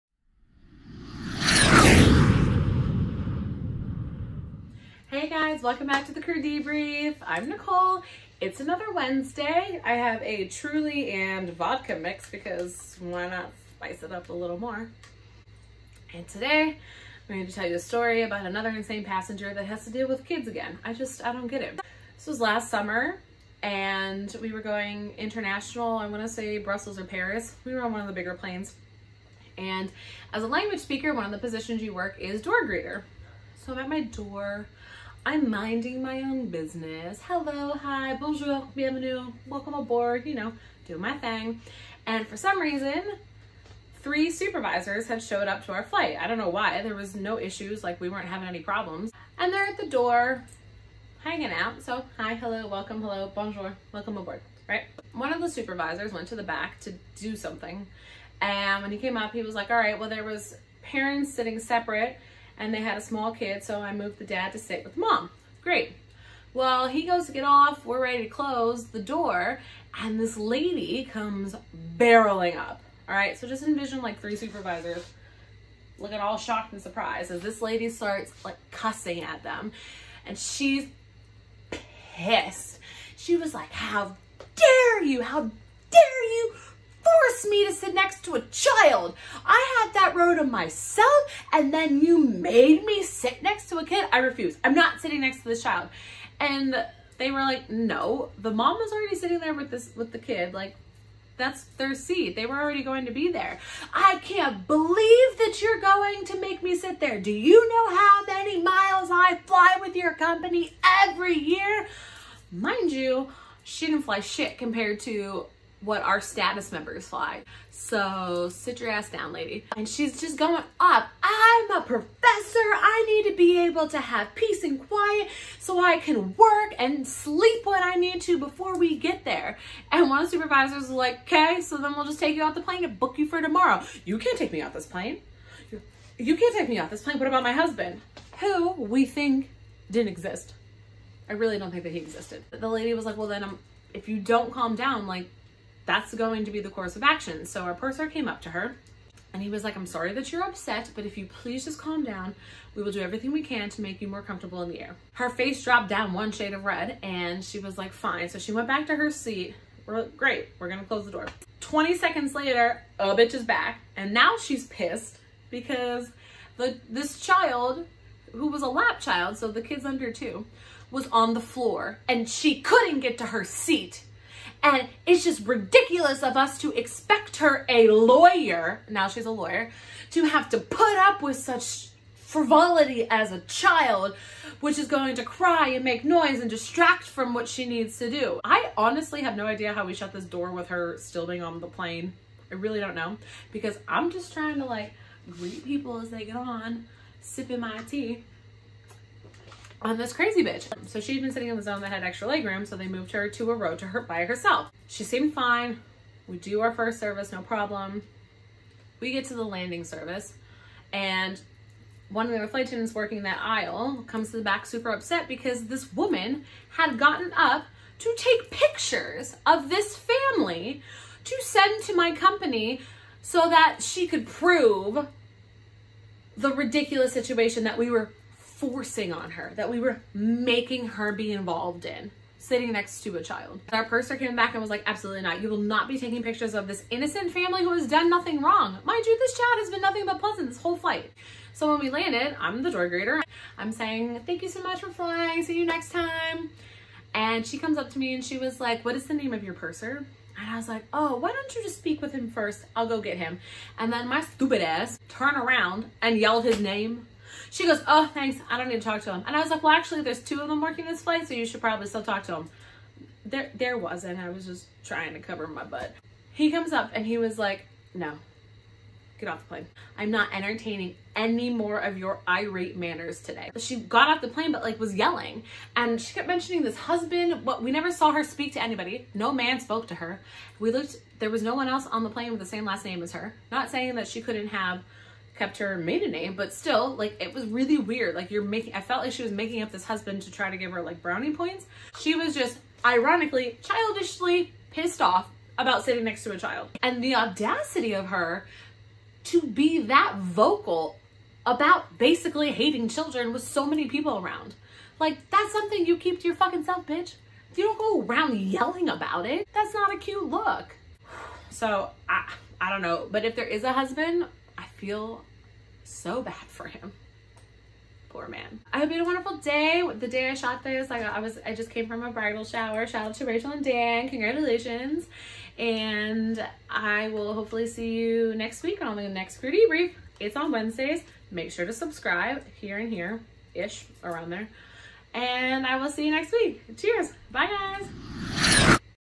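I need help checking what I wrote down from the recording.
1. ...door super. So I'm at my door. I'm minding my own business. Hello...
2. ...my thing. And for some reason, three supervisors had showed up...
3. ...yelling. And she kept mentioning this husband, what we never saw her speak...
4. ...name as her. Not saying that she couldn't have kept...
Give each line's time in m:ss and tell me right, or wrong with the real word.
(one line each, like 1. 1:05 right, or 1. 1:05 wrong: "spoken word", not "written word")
1. 0:32 wrong: "greeter", not "super"
2. 0:40 right
3. 4:34 right
4. 4:42 right.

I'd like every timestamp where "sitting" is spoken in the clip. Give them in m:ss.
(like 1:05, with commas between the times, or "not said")
1:01, 1:34, 1:39, 3:21, 3:52, 4:55.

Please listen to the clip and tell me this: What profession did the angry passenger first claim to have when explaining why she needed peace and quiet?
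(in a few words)
professor.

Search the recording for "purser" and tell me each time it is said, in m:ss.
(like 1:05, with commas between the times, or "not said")
2:27, 3:53, 4:09.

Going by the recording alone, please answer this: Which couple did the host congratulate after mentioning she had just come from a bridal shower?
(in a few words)
Rachel and Dan.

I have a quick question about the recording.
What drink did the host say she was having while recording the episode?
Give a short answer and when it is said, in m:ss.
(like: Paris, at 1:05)
Truly and vodka mix, at 0:10.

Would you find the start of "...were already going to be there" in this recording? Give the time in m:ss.
1:42.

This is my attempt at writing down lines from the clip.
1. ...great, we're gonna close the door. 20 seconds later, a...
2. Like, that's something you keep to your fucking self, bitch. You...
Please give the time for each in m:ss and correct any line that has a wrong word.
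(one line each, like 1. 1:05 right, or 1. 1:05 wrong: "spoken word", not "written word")
1. 2:40 right
2. 5:04 right.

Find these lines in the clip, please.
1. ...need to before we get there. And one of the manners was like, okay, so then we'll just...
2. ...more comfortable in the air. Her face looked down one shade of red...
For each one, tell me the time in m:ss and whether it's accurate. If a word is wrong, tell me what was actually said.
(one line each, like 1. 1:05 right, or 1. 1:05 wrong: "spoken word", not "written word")
1. 2:07 wrong: "supervisors", not "manners"
2. 2:34 wrong: "dropped", not "looked".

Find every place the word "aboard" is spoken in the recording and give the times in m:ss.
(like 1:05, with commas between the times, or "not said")
0:39, 0:54.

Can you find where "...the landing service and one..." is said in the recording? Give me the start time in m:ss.
3:29.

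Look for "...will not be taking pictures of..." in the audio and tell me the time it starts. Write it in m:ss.
3:55.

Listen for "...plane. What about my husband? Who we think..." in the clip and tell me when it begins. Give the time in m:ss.
2:17.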